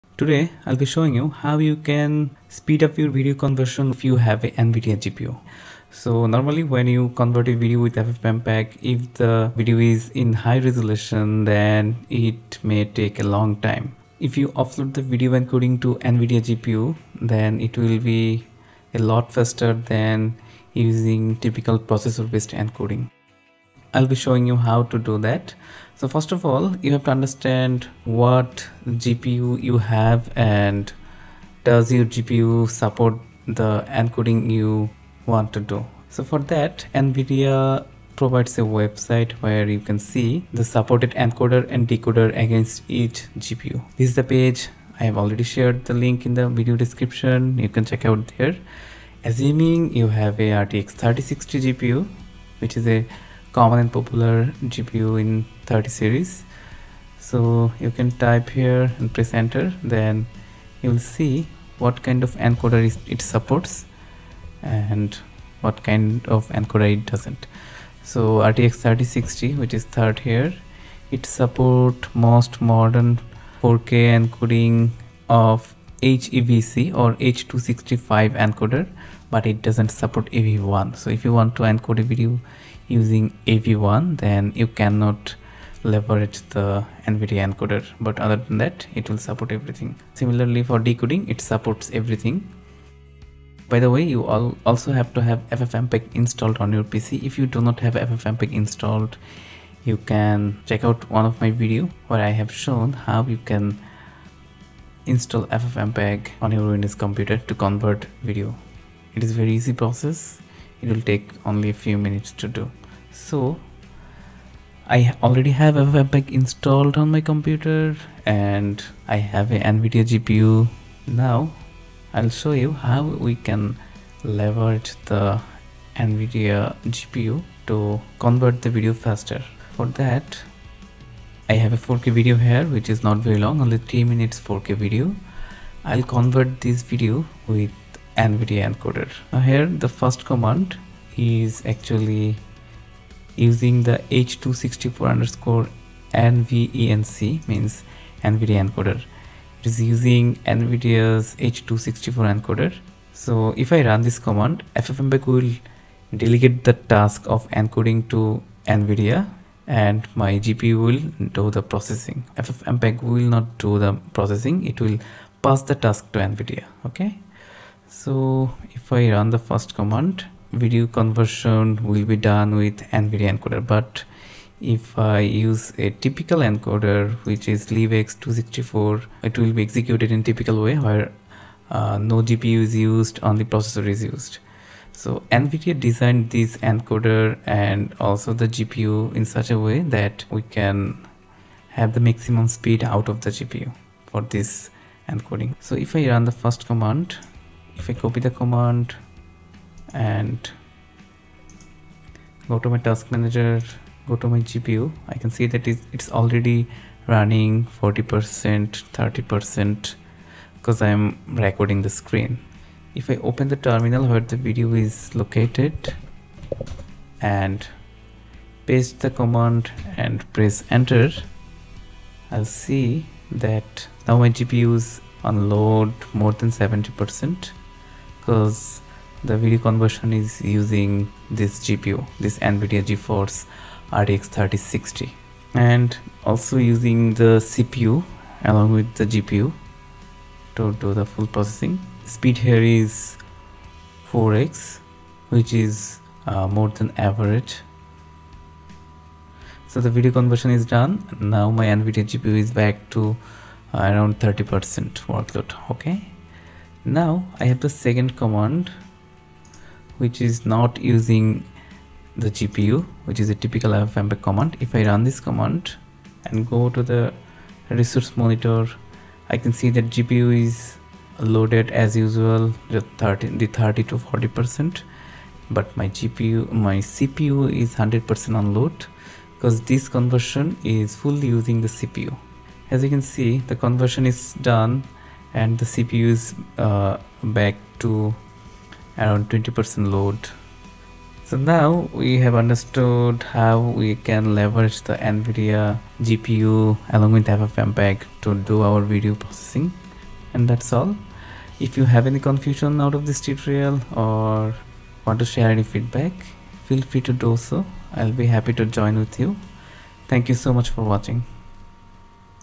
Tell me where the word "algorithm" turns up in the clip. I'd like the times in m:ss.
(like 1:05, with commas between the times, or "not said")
not said.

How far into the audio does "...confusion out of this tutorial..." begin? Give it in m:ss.
5:02.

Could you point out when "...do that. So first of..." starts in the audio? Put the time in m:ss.
0:24.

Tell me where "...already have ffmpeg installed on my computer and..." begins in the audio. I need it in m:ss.
1:55.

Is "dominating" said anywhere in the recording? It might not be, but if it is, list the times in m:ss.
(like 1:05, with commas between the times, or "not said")
not said.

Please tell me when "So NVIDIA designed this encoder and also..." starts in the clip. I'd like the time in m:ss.
3:05.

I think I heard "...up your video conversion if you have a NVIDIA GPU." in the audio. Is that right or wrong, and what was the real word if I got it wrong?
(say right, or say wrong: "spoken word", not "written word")
right.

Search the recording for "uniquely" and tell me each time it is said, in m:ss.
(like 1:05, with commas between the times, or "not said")
not said.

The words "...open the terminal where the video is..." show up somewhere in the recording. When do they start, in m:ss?
3:33.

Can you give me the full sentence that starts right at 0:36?
So for that, NVIDIA provides a website where you can see the supported encoder and decoder against each GPU.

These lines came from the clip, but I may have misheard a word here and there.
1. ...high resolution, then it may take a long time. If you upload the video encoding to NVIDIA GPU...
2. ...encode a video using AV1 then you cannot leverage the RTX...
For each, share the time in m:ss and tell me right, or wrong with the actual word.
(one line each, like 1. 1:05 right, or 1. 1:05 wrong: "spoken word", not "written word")
1. 0:10 right
2. 1:21 wrong: "NVIDIA", not "RTX".